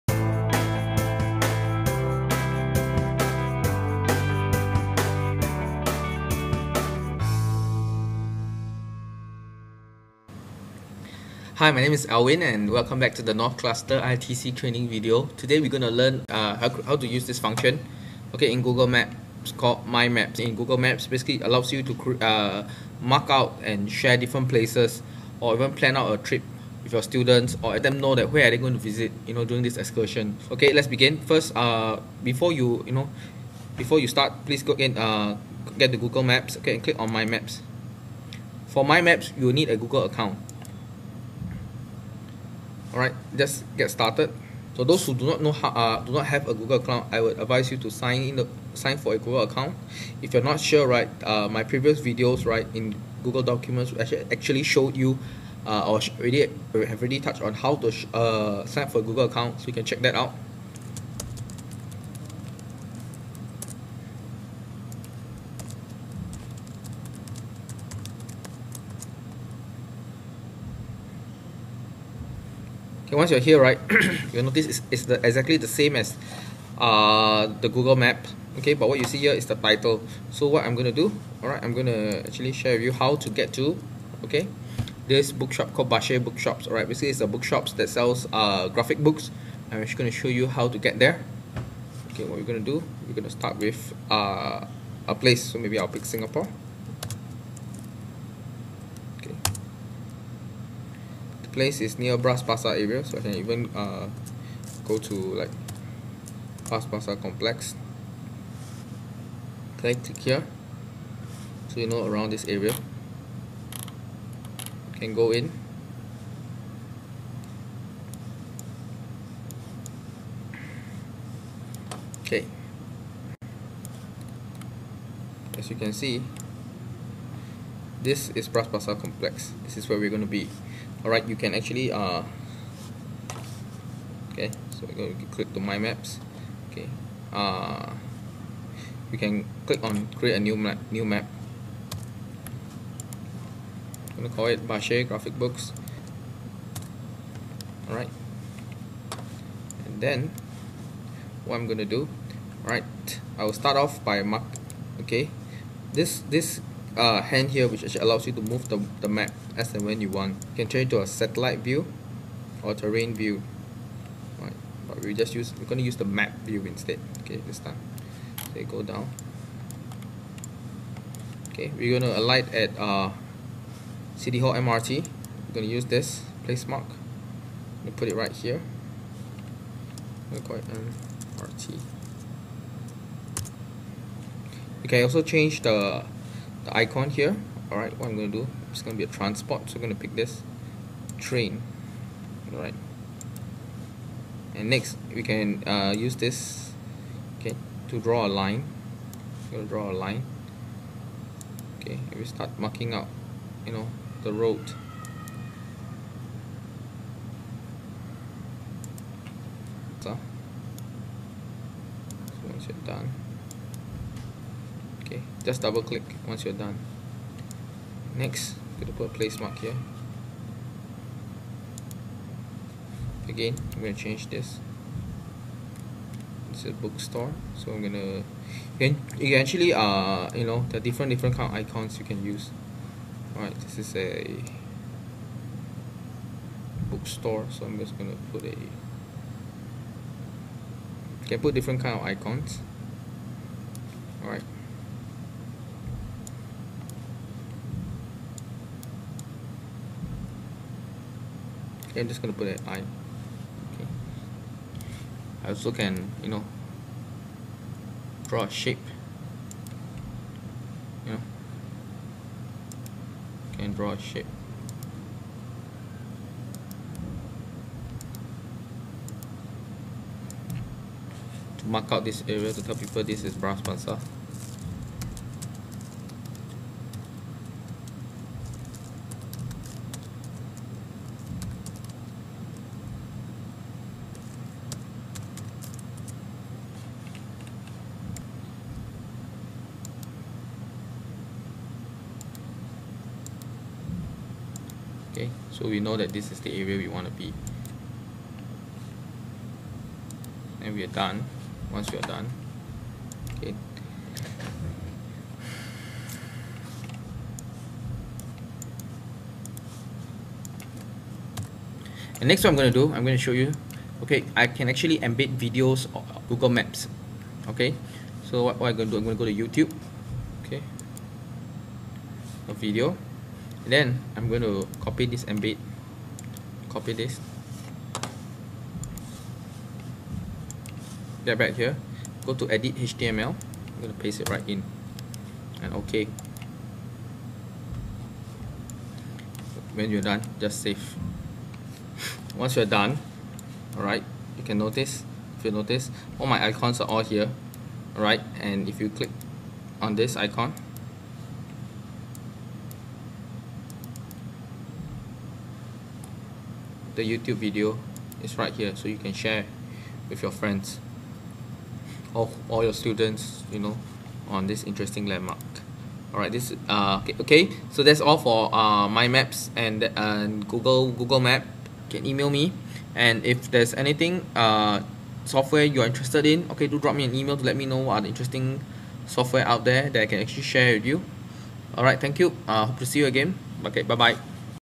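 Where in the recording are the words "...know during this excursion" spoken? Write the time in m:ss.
0:29.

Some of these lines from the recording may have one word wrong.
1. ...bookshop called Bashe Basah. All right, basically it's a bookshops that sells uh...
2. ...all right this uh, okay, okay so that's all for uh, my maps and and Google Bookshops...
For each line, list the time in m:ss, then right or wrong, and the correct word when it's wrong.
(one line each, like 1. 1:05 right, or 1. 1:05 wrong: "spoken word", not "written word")
1. 1:25 wrong: "Bookshops", not "Basah"
2. 6:06 wrong: "Google", not "Bookshops".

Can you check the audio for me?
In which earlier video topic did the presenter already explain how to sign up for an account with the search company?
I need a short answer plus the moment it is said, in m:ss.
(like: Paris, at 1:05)
Google documents, at 0:53.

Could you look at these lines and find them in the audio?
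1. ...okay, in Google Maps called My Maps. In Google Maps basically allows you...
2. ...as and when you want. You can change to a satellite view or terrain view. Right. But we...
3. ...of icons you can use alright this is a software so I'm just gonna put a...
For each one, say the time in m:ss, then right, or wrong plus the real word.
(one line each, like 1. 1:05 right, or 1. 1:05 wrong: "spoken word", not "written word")
1. 0:18 right
2. 2:39 right
3. 3:51 wrong: "bookstore", not "software".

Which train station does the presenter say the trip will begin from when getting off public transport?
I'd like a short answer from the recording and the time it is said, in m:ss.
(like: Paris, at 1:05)
City Hall MRT, at 2:54.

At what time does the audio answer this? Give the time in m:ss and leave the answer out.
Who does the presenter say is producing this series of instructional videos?
0:13.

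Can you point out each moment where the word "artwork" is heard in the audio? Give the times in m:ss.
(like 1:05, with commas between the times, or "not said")
not said.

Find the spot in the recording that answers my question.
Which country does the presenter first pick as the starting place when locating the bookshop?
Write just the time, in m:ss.
1:36.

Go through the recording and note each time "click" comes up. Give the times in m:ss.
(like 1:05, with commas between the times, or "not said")
0:36, 1:49, 2:15, 2:19, 3:35, 5:48.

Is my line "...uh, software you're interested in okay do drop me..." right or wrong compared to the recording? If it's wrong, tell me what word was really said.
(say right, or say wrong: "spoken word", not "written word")
right.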